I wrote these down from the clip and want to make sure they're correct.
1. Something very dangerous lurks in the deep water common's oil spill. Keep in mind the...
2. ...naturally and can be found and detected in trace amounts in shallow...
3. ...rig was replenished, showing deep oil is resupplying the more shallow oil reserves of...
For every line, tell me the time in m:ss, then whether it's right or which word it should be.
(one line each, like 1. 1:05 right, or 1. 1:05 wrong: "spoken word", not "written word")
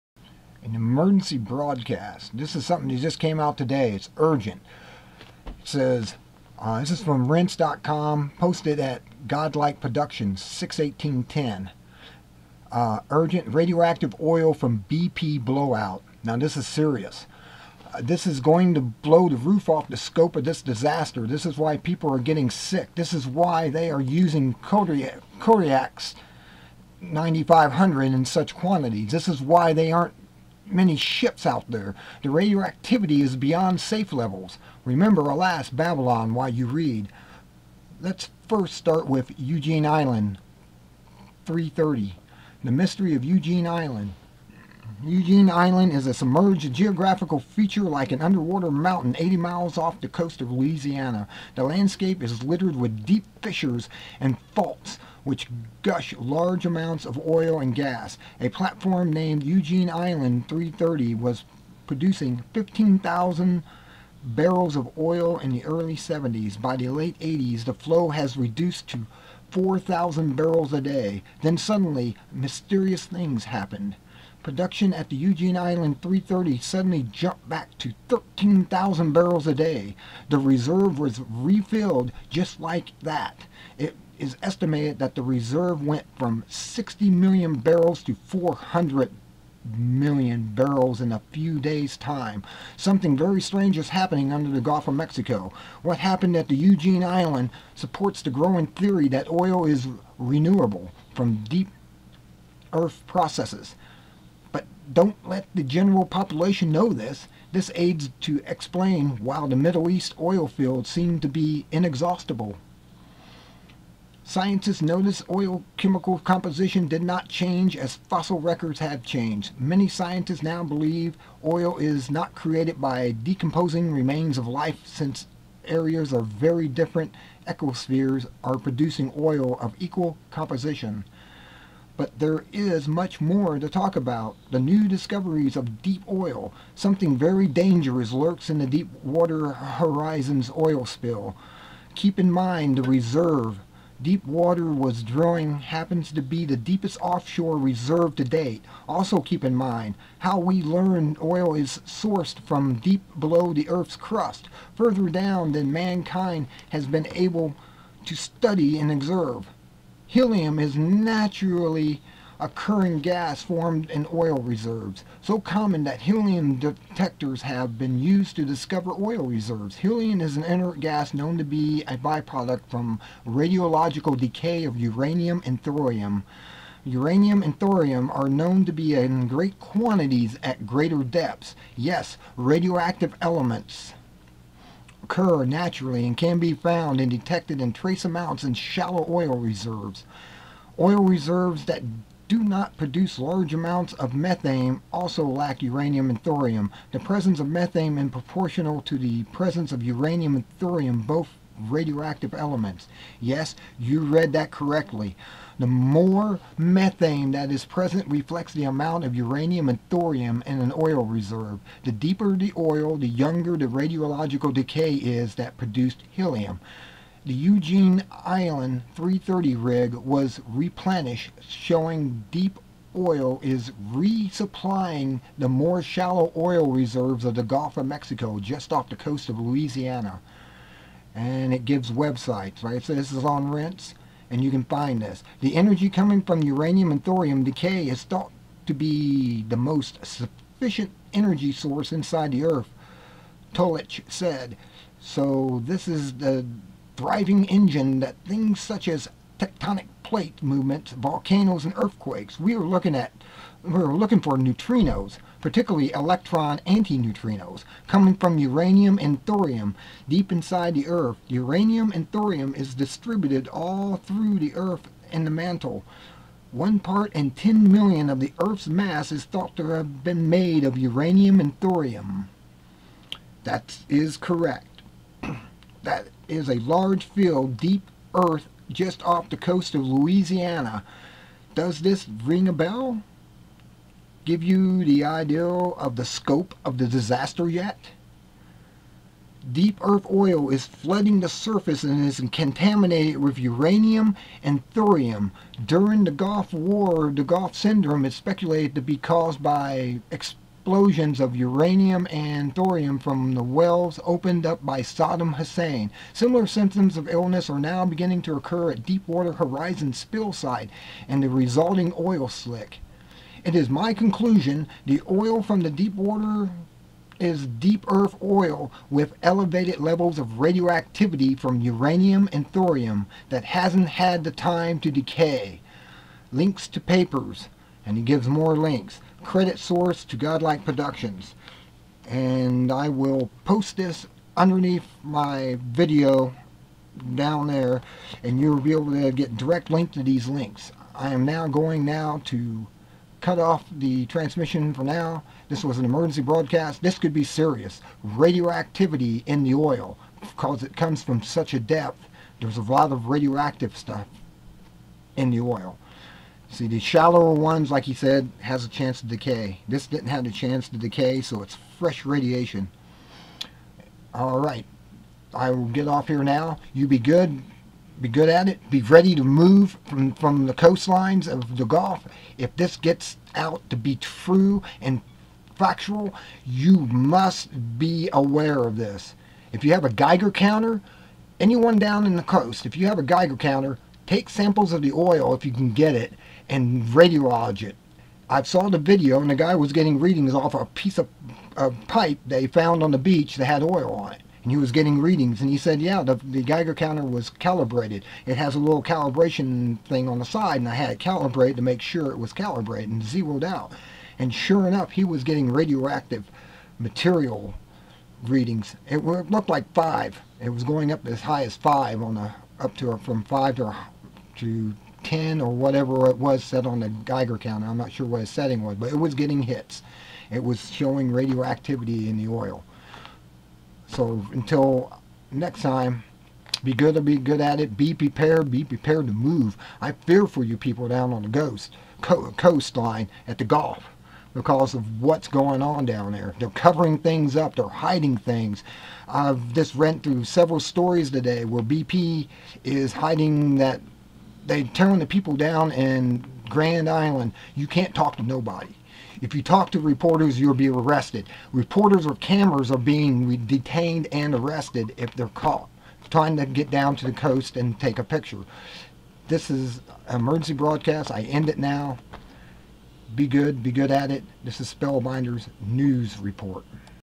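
1. 2:16 wrong: "horizon", not "common"
2. 3:05 right
3. 3:39 right.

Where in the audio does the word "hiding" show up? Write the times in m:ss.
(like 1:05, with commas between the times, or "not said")
7:17, 7:22.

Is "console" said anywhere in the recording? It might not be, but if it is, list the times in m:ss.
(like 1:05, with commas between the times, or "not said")
not said.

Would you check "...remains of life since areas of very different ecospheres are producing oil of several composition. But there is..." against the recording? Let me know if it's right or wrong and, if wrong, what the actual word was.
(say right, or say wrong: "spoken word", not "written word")
wrong: "equal", not "several".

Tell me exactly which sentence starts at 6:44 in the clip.
And sure enough, he was getting radioactive material readings.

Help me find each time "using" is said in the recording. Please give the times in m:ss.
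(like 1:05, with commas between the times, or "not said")
0:23.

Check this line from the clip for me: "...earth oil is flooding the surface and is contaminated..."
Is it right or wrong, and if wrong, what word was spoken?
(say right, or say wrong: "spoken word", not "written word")
right.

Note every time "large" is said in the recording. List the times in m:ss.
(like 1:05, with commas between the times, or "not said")
0:56, 3:13, 4:36.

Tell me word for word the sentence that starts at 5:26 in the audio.
Links to papers, and he gives more links credit source to Godlike Productions.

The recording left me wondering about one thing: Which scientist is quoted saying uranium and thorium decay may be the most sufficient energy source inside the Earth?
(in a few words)
Tolich.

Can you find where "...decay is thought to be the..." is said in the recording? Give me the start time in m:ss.
3:57.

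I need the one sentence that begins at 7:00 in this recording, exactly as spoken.
It was showing radioactivity in the oil.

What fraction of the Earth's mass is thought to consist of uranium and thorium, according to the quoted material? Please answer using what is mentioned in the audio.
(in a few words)
One part in 10 million.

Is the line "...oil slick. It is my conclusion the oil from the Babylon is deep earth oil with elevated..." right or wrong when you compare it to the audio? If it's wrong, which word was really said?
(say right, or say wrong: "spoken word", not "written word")
wrong: "Deepwater", not "Babylon".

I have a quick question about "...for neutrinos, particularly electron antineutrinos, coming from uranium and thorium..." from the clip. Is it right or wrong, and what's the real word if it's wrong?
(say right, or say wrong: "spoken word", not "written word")
right.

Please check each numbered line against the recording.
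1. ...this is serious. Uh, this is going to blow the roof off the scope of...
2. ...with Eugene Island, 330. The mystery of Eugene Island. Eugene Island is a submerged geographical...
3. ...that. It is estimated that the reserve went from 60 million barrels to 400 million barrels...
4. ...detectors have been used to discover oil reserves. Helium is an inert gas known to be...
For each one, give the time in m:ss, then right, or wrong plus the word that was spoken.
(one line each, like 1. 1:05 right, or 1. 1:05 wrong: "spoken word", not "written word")
1. 0:16 right
2. 0:39 right
3. 1:23 right
4. 2:46 right.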